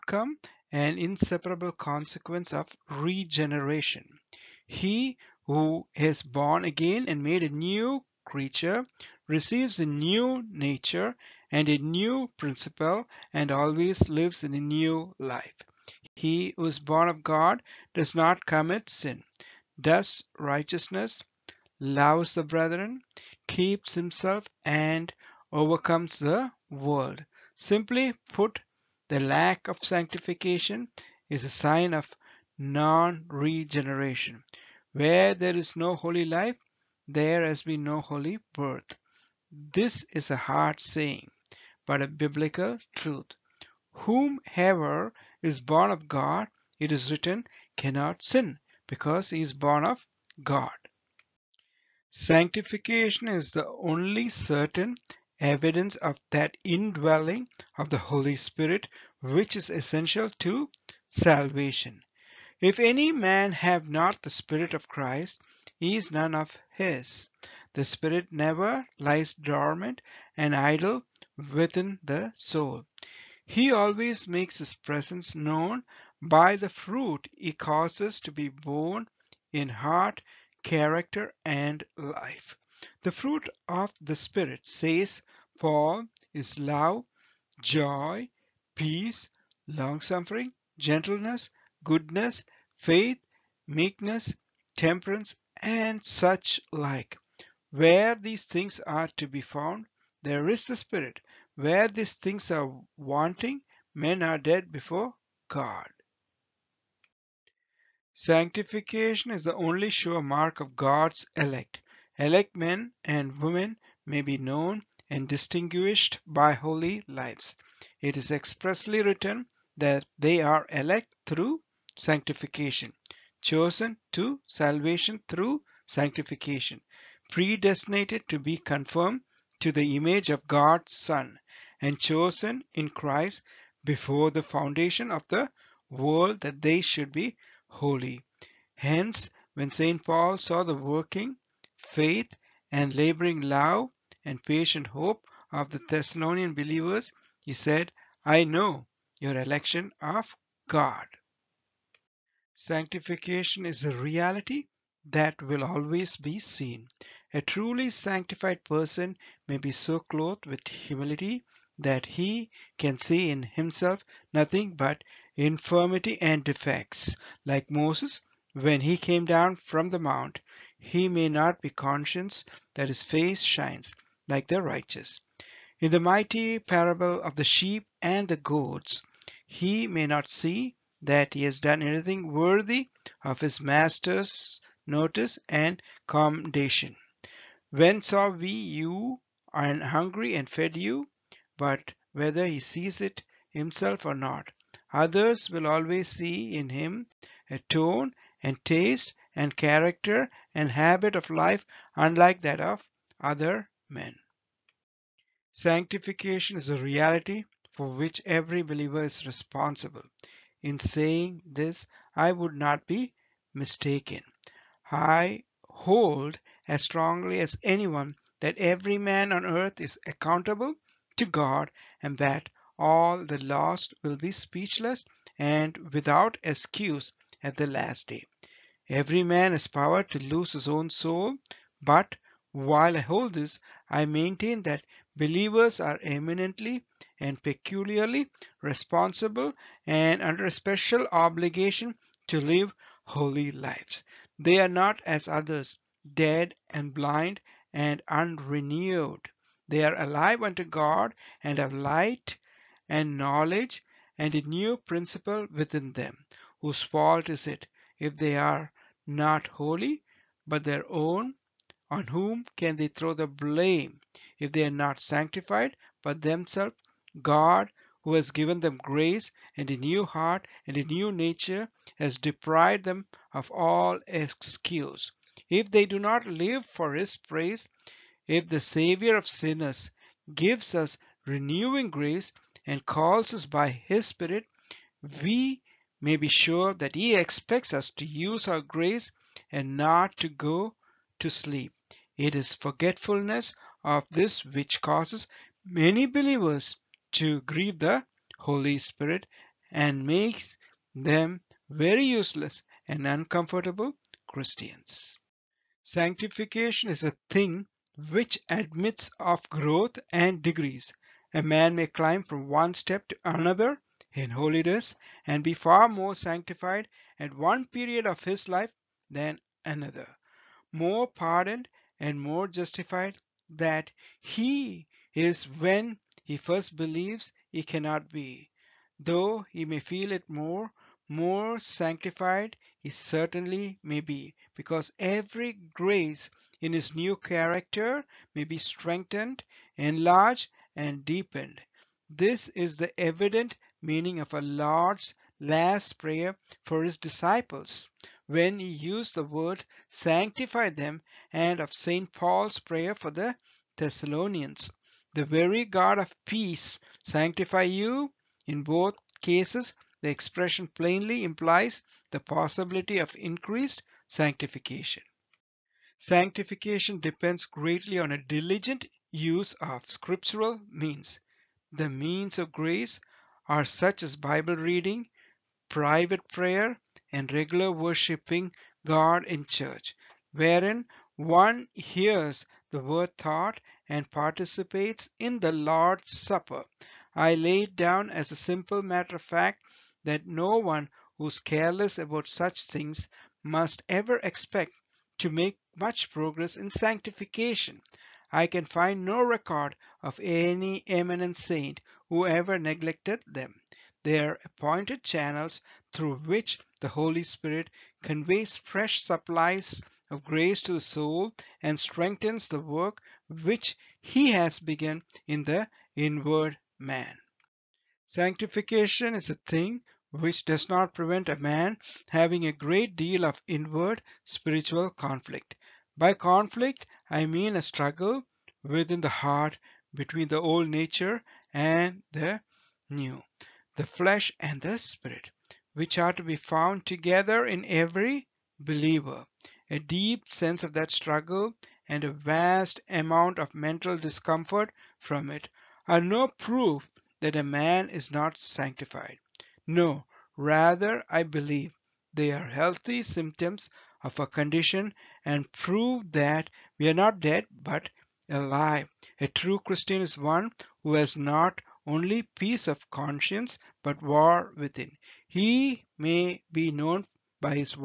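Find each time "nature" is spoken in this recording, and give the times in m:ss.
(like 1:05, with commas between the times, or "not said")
0:10, 4:31, 7:10.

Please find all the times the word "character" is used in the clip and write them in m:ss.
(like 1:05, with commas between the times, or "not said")
1:20, 3:19, 5:37.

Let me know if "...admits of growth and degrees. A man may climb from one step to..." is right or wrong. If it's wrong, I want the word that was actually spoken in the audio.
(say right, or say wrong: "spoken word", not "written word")
right.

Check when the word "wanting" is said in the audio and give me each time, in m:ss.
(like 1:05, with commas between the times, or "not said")
1:42.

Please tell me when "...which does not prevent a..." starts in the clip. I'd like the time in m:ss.
7:00.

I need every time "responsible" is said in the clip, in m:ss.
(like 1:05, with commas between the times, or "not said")
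3:29, 3:58.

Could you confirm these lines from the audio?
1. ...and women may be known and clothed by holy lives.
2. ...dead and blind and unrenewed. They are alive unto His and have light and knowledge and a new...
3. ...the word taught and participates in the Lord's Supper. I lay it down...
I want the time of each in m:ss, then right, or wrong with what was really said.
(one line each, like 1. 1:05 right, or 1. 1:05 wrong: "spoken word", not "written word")
1. 1:53 wrong: "distinguished", not "clothed"
2. 4:06 wrong: "God", not "His"
3. 6:22 right.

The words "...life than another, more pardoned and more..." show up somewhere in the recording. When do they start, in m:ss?
5:18.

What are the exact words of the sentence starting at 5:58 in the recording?
In both cases, the expression plainly implies the possibility of increased sanctification.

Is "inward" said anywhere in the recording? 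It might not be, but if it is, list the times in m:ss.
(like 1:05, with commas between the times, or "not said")
6:55, 7:03.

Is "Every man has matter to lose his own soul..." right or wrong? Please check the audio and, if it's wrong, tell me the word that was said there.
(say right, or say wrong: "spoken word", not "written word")
wrong: "power", not "matter".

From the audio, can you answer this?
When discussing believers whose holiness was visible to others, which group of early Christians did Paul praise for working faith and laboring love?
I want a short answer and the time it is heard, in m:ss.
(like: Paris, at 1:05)
Thessalonian believers, at 2:25.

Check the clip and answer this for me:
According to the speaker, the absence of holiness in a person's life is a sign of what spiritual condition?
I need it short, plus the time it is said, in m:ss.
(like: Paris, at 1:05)
Non regeneration, at 0:32.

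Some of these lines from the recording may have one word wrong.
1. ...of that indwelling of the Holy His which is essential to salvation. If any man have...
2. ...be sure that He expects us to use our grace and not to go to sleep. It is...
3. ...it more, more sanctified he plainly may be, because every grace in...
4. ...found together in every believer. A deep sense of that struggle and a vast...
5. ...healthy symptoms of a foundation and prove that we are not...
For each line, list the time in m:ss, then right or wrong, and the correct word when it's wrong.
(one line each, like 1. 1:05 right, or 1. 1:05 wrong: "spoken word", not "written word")
1. 0:55 wrong: "Spirit", not "His"
2. 4:46 right
3. 5:30 wrong: "certainly", not "plainly"
4. 7:16 right
5. 7:32 wrong: "condition", not "foundation".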